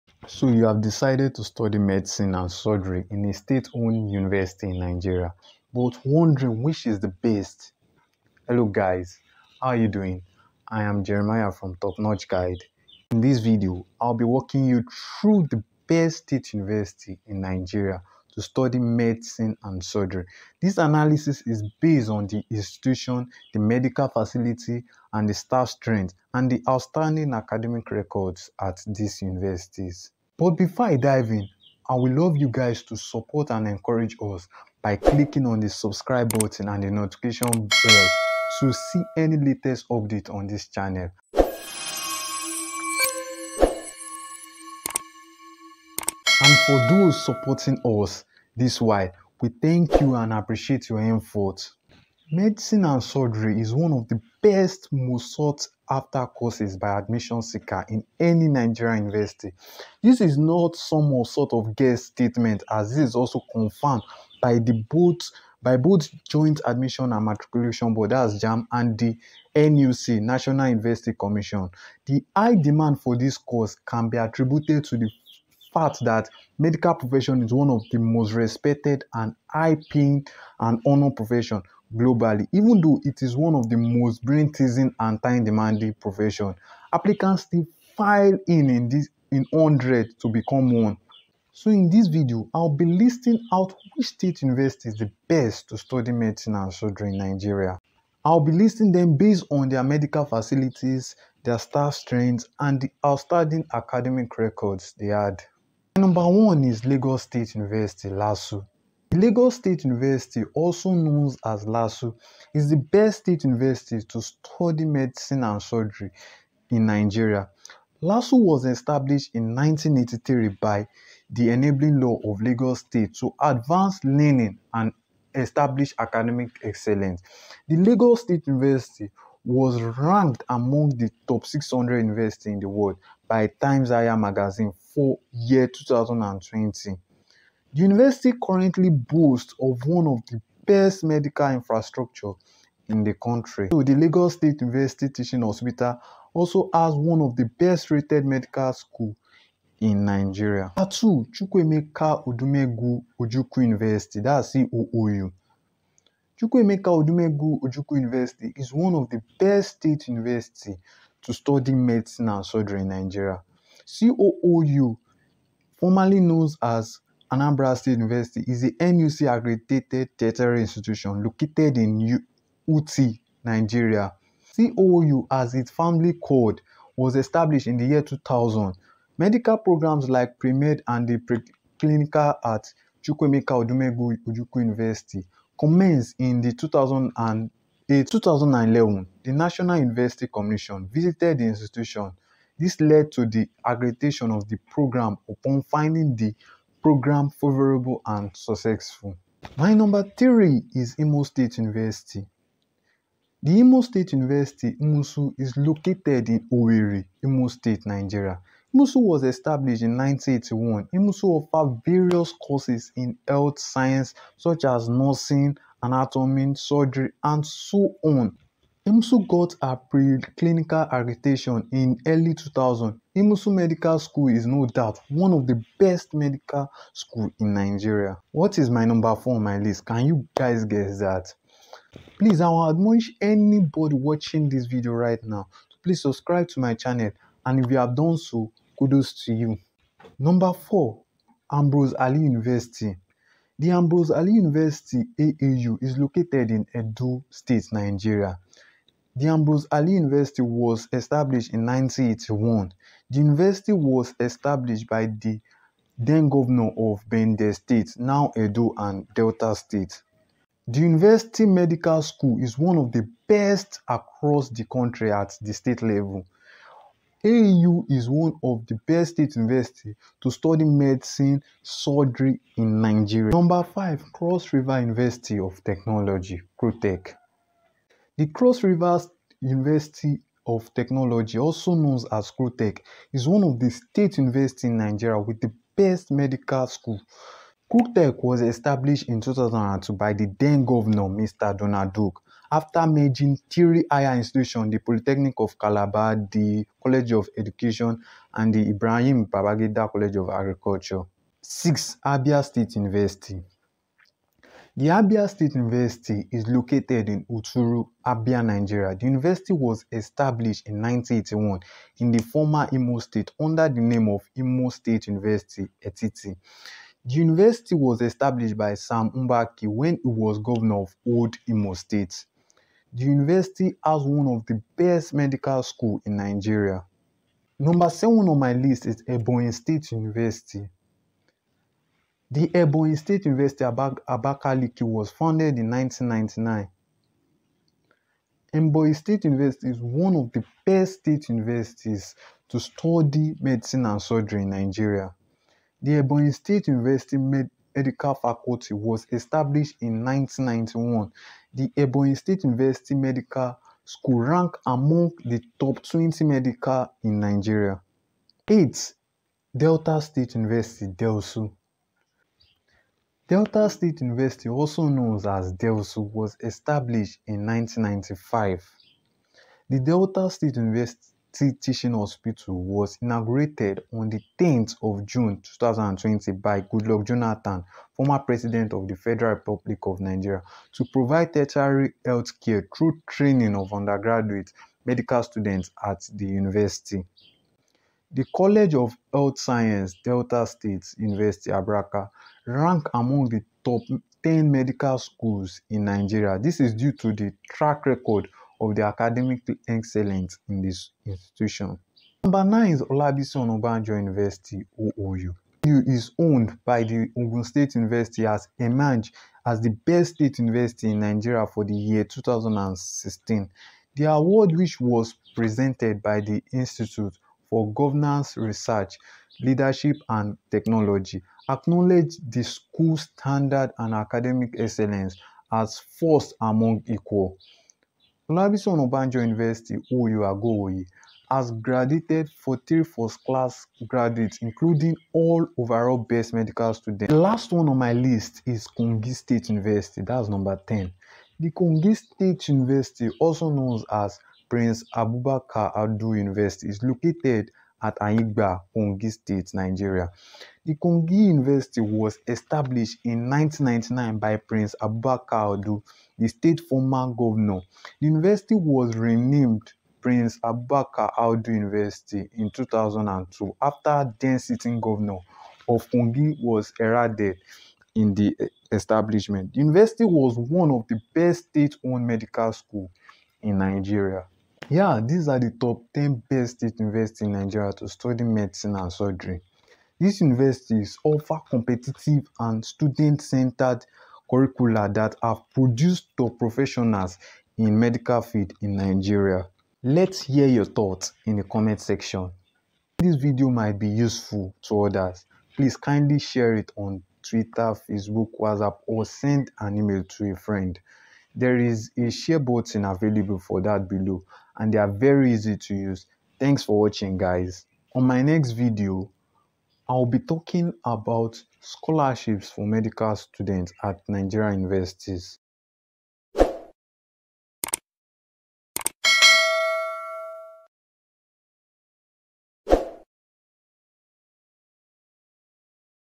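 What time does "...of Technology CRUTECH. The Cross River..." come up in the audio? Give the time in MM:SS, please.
04:35.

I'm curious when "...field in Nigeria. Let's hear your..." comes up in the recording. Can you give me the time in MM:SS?
08:08.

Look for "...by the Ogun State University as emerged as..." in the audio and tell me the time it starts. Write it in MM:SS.
06:46.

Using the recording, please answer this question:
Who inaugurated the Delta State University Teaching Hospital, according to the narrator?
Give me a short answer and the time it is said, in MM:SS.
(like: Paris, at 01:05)
Goodluck Jonathan, at 06:16.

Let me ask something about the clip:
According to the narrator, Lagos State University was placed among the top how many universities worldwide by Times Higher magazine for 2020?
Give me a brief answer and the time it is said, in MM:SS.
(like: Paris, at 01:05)
600, at 02:11.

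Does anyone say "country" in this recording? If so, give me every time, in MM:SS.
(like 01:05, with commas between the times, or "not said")
02:23, 04:24.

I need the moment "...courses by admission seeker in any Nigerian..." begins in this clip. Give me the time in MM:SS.
00:56.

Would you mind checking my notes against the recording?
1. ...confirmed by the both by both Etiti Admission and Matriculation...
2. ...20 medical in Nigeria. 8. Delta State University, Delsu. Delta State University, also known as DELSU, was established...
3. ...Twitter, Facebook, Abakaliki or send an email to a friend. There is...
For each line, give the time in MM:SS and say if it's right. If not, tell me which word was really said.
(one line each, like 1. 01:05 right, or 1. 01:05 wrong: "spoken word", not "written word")
1. 01:03 wrong: "Joint", not "Etiti"
2. 05:55 right
3. 08:17 wrong: "WhatsApp", not "Abakaliki".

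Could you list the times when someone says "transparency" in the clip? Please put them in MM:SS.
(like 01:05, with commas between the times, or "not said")
not said.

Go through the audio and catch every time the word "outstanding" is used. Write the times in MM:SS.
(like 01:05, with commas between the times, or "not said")
00:26, 01:43.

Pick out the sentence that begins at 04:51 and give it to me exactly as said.
Donald Duke, after merging three higher institutions, the Polytechnic of Calabar, the College of Education, and the Ibrahim Babangida College of Agriculture.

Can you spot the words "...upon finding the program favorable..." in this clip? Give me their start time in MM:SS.
03:15.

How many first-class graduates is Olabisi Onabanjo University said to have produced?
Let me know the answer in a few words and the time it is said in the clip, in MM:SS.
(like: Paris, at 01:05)
40, at 07:12.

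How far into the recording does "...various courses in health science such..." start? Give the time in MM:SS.
03:31.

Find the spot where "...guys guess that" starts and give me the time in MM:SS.
03:50.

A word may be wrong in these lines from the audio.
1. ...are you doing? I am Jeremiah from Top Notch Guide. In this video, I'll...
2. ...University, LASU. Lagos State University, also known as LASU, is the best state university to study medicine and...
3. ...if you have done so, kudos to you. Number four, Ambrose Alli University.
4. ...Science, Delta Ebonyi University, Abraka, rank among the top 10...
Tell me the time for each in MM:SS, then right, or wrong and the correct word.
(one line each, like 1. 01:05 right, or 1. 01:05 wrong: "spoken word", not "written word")
1. 00:09 right
2. 01:47 right
3. 03:57 right
4. 06:29 wrong: "State", not "Ebonyi".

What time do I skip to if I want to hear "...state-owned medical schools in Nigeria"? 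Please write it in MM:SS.
07:51.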